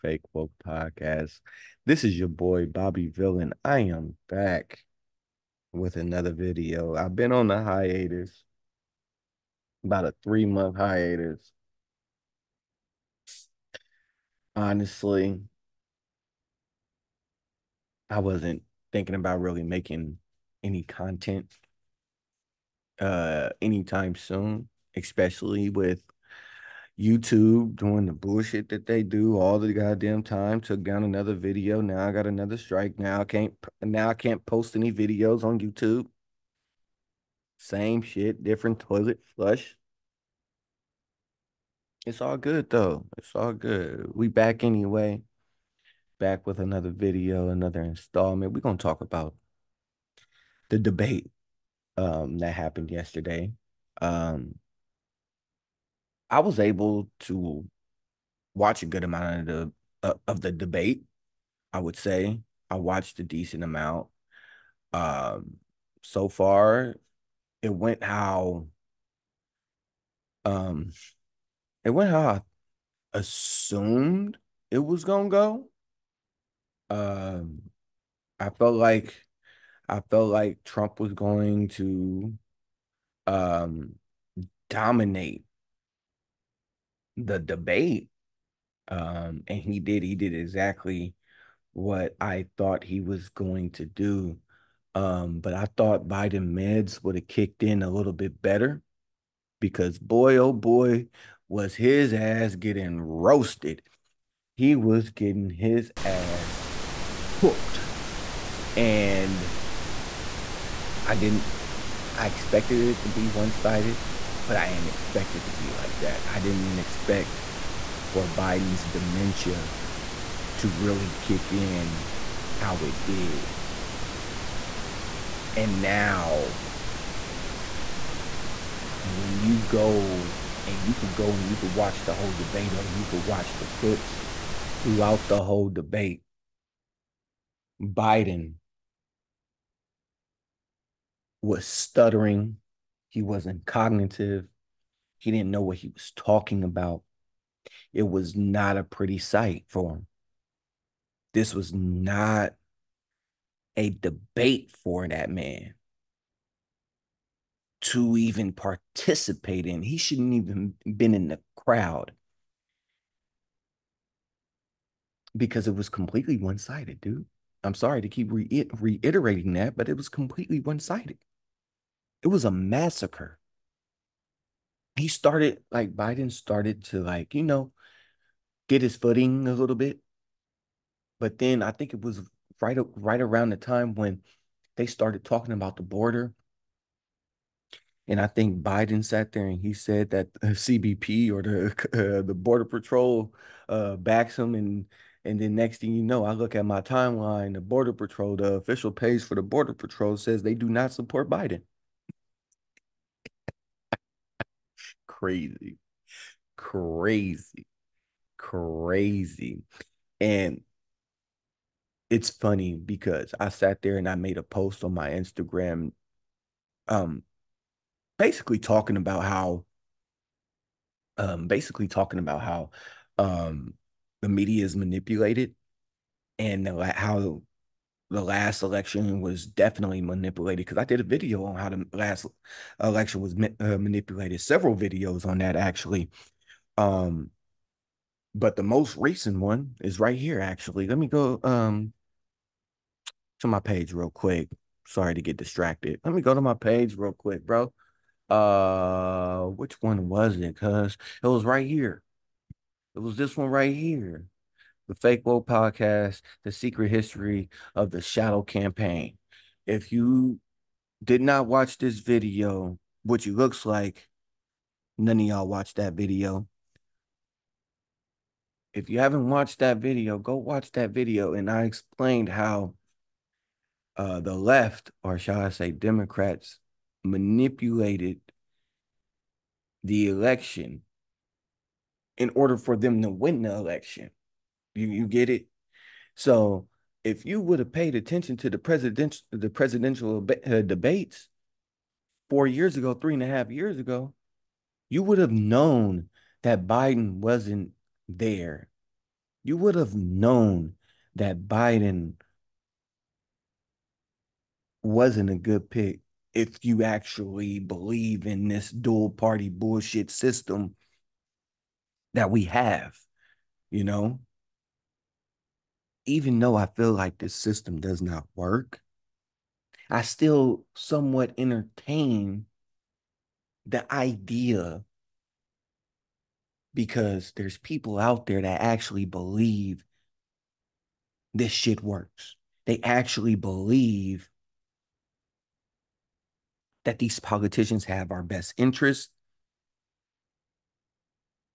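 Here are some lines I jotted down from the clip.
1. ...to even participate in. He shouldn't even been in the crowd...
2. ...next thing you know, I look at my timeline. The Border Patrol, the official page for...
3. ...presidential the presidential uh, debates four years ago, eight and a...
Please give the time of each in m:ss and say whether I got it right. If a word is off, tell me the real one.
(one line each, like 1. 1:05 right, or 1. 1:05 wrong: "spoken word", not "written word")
1. 2:37 right
2. 3:15 right
3. 4:48 wrong: "three", not "eight".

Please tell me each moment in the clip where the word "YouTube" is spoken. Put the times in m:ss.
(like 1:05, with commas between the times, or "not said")
0:26, 0:35.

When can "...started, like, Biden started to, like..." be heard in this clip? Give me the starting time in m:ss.
2:55.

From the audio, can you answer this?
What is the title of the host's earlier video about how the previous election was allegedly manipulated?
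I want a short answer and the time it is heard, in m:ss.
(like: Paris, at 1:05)
The Secret History of the Shadow Campaign, at 4:16.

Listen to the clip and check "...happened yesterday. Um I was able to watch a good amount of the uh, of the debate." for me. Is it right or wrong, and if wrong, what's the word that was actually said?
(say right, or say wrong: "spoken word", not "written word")
right.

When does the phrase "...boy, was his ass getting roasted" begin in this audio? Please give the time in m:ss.
1:40.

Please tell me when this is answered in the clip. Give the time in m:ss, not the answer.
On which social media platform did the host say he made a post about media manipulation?
3:35.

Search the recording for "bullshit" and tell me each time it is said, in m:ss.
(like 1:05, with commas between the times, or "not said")
0:28, 5:09.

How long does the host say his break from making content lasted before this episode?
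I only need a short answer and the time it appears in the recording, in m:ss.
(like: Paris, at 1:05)
3 months, at 0:10.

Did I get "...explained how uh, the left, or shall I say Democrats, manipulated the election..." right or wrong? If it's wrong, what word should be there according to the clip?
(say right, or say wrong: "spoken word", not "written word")
right.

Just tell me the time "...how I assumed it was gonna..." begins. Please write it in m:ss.
1:12.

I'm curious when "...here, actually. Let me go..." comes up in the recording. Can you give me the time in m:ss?
4:00.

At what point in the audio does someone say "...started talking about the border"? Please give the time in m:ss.
3:04.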